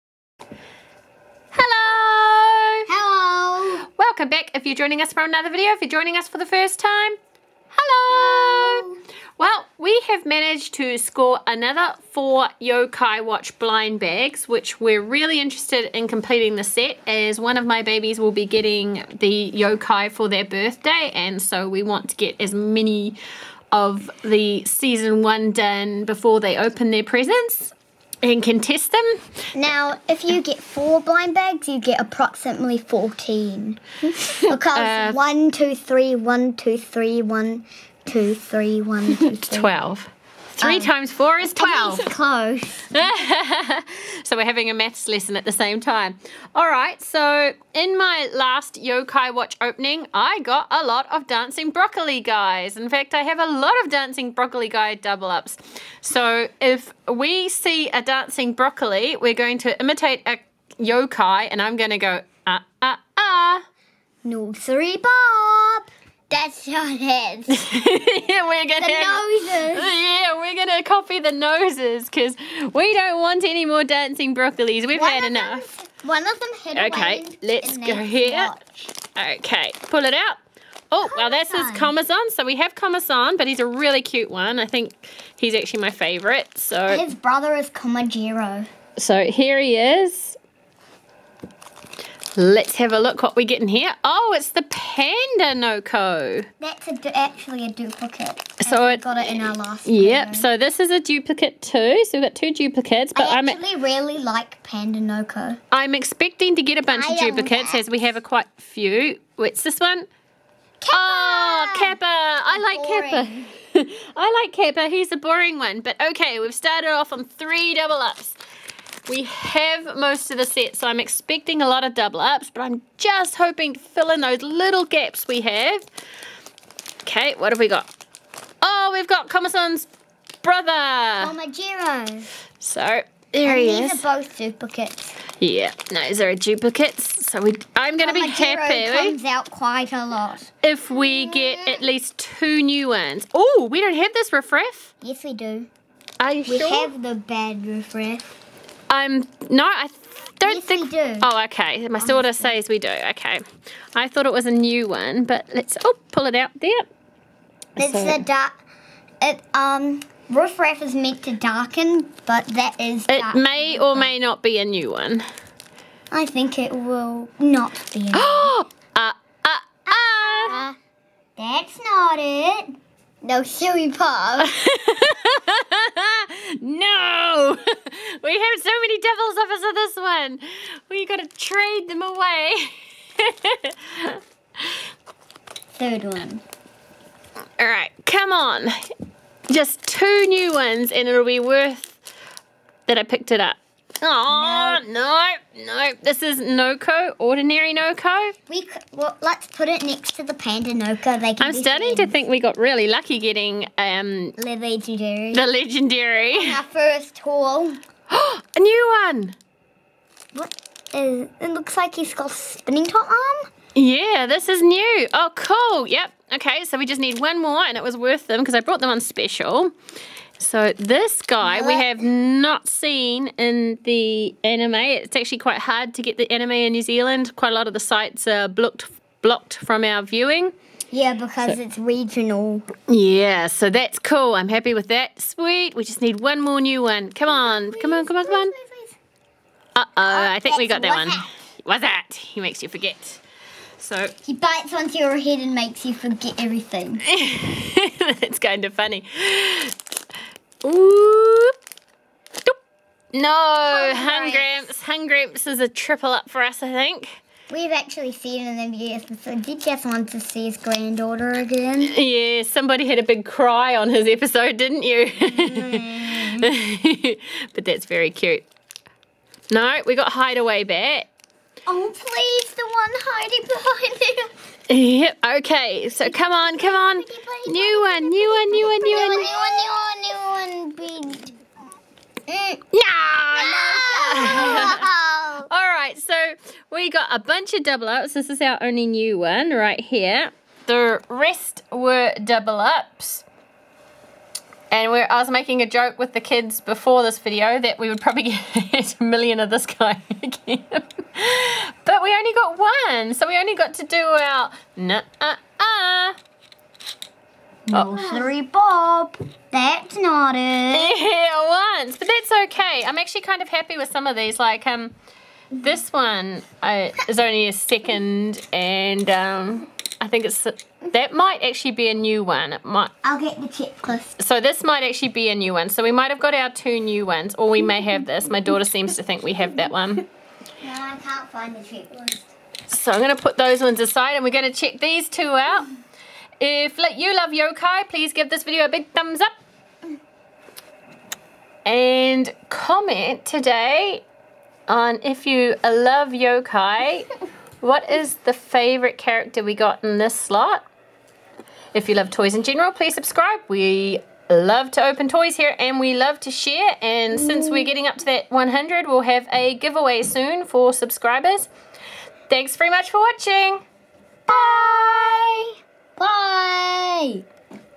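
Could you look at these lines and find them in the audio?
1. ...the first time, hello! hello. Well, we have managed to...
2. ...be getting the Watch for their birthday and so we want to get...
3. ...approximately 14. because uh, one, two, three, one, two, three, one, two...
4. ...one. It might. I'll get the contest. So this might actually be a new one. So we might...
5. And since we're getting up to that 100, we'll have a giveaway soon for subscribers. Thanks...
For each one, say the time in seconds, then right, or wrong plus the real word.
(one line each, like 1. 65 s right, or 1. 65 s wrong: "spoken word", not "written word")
1. 6 s right
2. 18 s wrong: "Yokai", not "Watch"
3. 31 s right
4. 322 s wrong: "checklist", not "contest"
5. 356 s right.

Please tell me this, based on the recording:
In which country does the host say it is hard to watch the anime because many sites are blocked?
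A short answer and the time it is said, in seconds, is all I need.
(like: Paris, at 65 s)
New Zealand, at 226 s.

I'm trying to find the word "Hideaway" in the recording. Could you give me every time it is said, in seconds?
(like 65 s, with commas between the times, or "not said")
270 s.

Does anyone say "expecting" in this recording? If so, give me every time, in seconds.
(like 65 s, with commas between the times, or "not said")
105 s, 121 s.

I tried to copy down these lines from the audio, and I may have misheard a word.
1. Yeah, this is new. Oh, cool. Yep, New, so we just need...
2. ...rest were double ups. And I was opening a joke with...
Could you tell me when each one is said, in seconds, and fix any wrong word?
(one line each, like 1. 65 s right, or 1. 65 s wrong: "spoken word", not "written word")
1. 213 s wrong: "Okay", not "New"
2. 291 s wrong: "making", not "opening".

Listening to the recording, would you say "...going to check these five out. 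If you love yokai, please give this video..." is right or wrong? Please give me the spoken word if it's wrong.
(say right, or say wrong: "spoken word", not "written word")
wrong: "two", not "five".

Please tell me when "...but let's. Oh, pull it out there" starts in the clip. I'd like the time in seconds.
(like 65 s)
155 s.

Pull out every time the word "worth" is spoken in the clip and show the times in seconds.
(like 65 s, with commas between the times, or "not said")
191 s, 217 s.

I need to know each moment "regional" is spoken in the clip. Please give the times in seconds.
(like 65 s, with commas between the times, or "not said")
231 s.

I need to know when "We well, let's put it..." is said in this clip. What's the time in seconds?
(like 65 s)
198 s.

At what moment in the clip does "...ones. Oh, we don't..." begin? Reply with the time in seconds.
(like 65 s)
142 s.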